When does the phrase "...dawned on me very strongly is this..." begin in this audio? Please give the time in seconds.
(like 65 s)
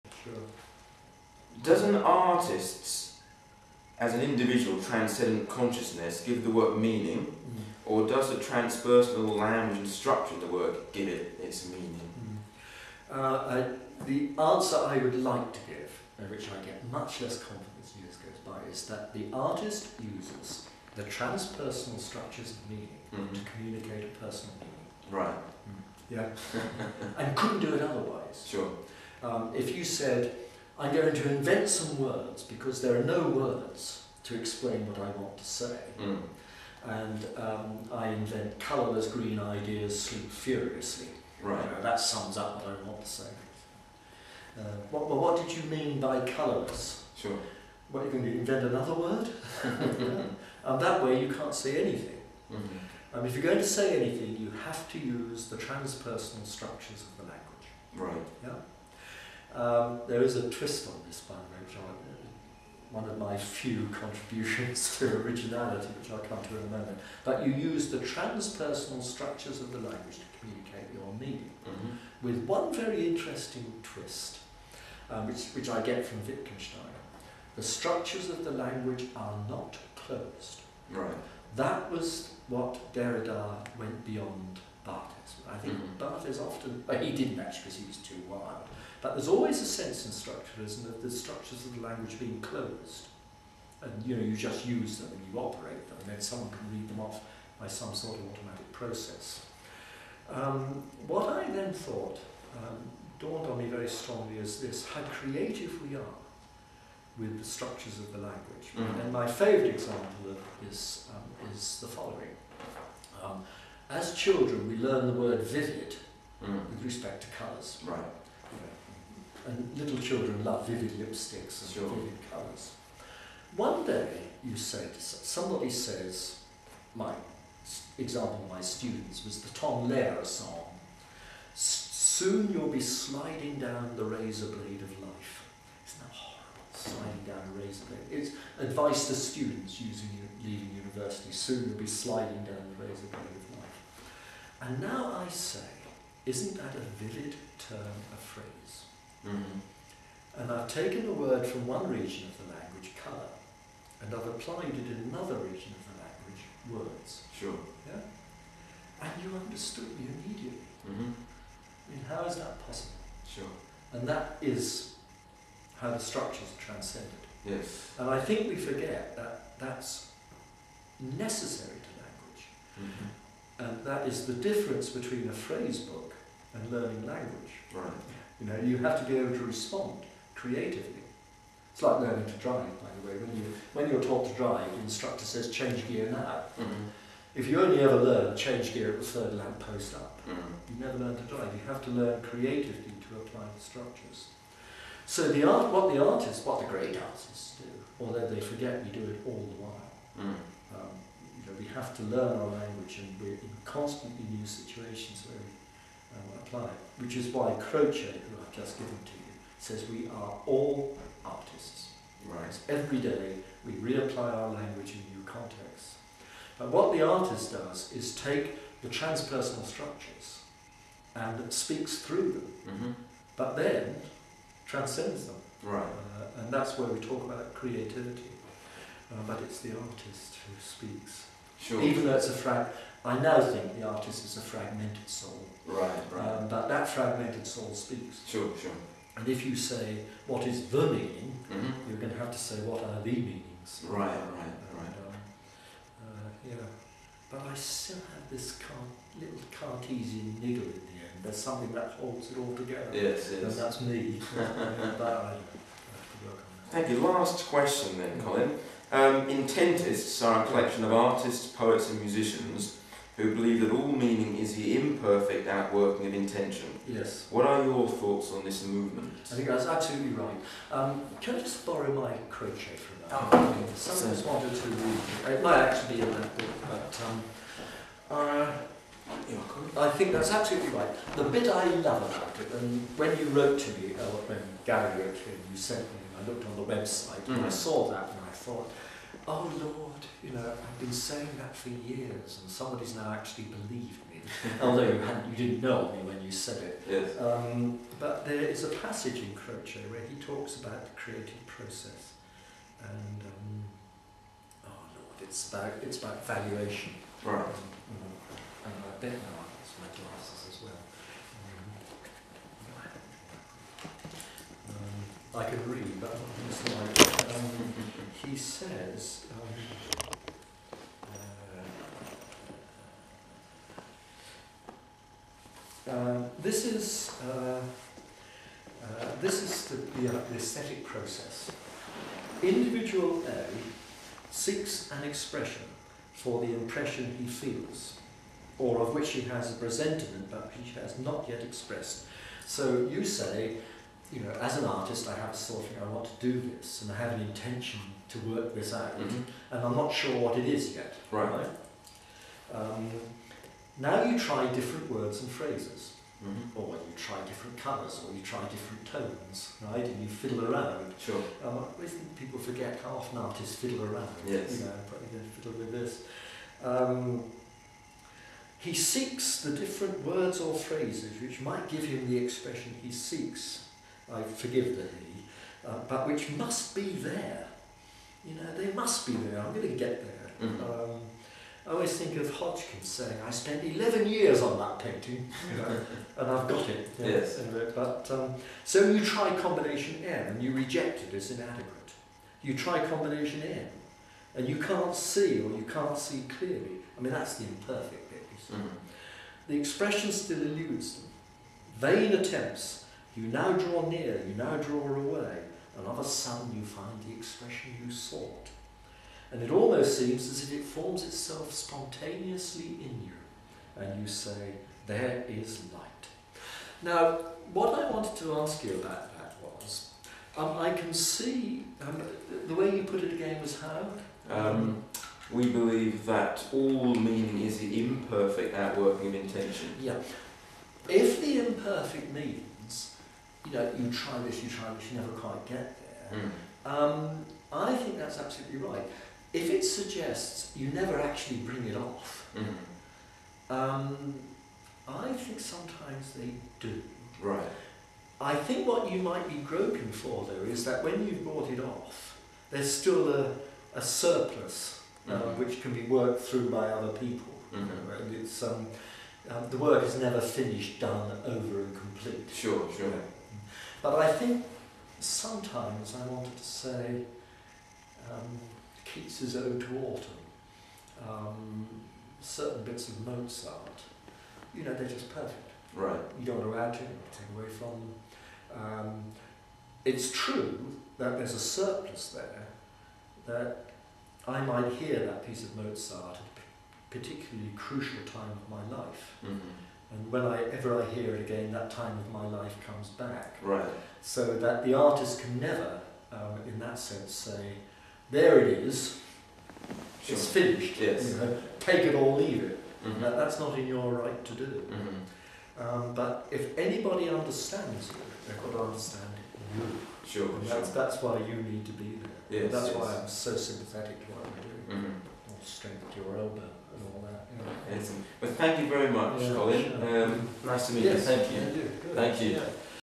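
103 s.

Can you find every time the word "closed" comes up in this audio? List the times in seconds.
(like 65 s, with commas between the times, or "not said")
80 s, 92 s.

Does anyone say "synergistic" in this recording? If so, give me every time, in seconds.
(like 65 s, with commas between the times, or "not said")
not said.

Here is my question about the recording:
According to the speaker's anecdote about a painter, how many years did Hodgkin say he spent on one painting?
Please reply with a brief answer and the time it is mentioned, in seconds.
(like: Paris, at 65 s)
11, at 383 s.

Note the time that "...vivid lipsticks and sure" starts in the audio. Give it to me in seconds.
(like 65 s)
120 s.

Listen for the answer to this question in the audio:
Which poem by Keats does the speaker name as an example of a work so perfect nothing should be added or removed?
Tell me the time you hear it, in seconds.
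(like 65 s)
469 s.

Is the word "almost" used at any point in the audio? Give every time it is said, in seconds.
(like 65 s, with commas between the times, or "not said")
409 s.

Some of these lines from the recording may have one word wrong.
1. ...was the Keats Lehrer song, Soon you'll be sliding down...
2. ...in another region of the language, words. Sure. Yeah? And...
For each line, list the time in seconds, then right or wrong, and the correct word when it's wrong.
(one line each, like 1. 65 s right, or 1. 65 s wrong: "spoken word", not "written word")
1. 129 s wrong: "Tom", not "Keats"
2. 154 s right.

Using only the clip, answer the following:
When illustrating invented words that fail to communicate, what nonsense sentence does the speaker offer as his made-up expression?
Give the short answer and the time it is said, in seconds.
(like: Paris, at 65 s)
colourless green ideas sleep furiously, at 38 s.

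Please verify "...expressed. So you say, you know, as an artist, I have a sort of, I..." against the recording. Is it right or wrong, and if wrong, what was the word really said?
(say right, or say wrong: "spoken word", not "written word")
right.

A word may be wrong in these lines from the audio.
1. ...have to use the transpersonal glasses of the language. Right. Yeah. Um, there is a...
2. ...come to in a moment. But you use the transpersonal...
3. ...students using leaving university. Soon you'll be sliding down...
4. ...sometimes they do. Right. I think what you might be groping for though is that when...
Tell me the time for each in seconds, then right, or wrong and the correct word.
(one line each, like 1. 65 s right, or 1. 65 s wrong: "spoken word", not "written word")
1. 54 s wrong: "structures", not "glasses"
2. 66 s right
3. 139 s right
4. 445 s right.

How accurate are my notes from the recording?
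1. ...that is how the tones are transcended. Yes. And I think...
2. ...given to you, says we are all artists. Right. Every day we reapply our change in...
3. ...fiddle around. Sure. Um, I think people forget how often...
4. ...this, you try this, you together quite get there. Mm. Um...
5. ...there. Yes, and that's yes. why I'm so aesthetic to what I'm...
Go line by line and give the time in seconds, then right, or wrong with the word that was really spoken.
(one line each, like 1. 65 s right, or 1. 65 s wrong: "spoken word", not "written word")
1. 164 s wrong: "structures", not "tones"
2. 208 s wrong: "language", not "change"
3. 360 s right
4. 434 s wrong: "never", not "together"
5. 512 s wrong: "sympathetic", not "aesthetic".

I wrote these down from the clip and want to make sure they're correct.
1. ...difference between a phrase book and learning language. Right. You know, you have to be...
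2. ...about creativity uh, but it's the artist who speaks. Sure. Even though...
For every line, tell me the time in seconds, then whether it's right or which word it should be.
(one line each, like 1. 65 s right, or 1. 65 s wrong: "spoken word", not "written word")
1. 174 s right
2. 227 s right.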